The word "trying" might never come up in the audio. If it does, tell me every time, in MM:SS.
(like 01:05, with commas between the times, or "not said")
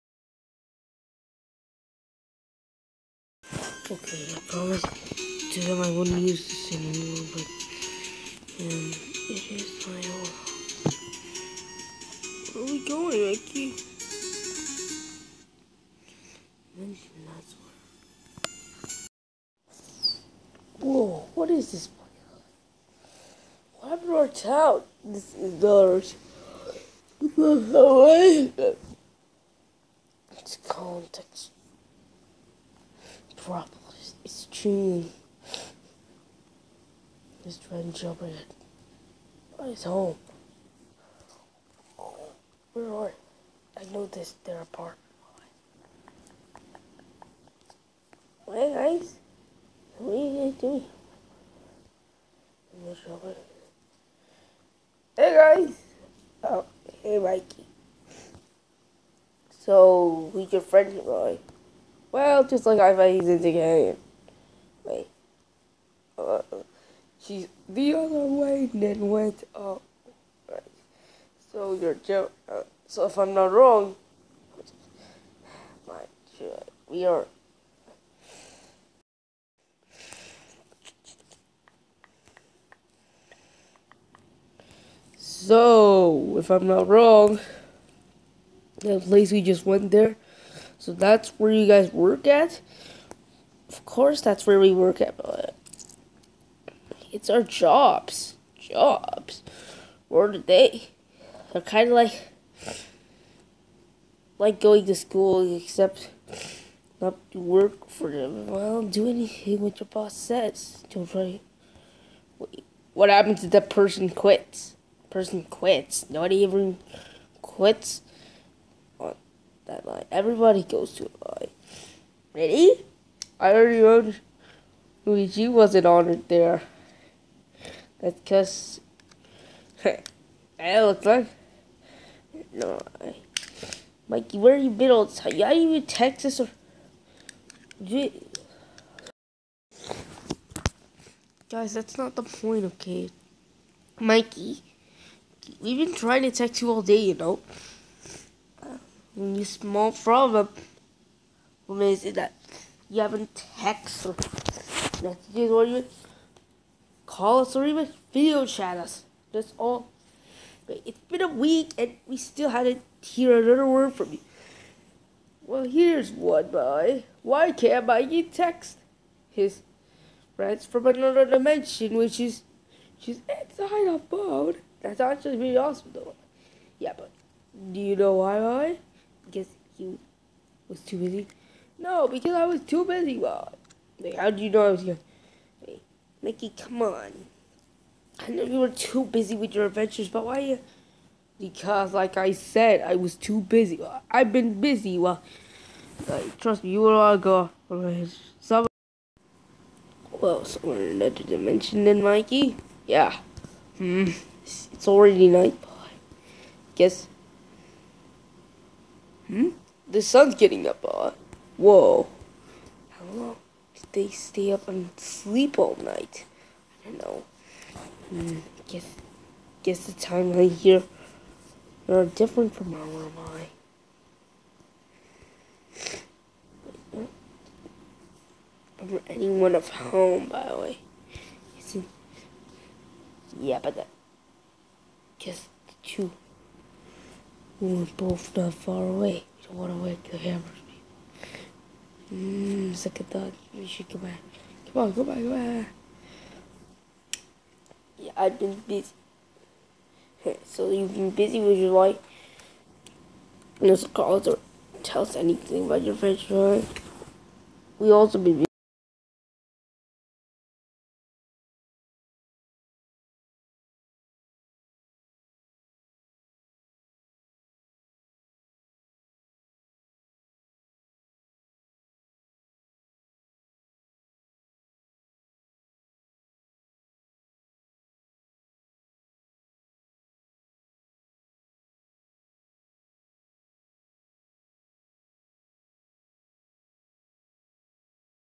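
00:37, 02:25.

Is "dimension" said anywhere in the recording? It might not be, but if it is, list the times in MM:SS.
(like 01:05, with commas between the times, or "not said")
02:51, 03:21.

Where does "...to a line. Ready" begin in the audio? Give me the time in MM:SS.
02:00.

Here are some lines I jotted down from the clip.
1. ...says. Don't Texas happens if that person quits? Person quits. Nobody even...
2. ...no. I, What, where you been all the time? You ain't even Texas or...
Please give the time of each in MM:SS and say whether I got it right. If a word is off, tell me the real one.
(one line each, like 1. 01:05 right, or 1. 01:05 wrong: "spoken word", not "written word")
1. 01:50 wrong: "What", not "Texas"
2. 02:12 wrong: "Mikey", not "What".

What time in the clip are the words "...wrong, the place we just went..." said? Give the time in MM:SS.
01:26.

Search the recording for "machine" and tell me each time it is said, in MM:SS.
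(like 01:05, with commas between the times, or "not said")
00:34.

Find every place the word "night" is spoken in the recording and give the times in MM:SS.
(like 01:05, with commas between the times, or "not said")
03:25, 03:35.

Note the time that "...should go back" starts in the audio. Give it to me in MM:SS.
04:03.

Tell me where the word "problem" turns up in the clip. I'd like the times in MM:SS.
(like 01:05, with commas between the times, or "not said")
00:33, 02:29.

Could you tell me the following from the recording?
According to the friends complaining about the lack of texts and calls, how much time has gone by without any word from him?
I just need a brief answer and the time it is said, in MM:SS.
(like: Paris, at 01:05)
a week, at 02:41.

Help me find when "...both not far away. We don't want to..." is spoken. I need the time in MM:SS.
03:57.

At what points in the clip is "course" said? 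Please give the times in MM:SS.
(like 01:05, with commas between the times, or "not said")
01:33.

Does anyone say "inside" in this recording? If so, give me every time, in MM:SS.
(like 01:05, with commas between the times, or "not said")
02:53.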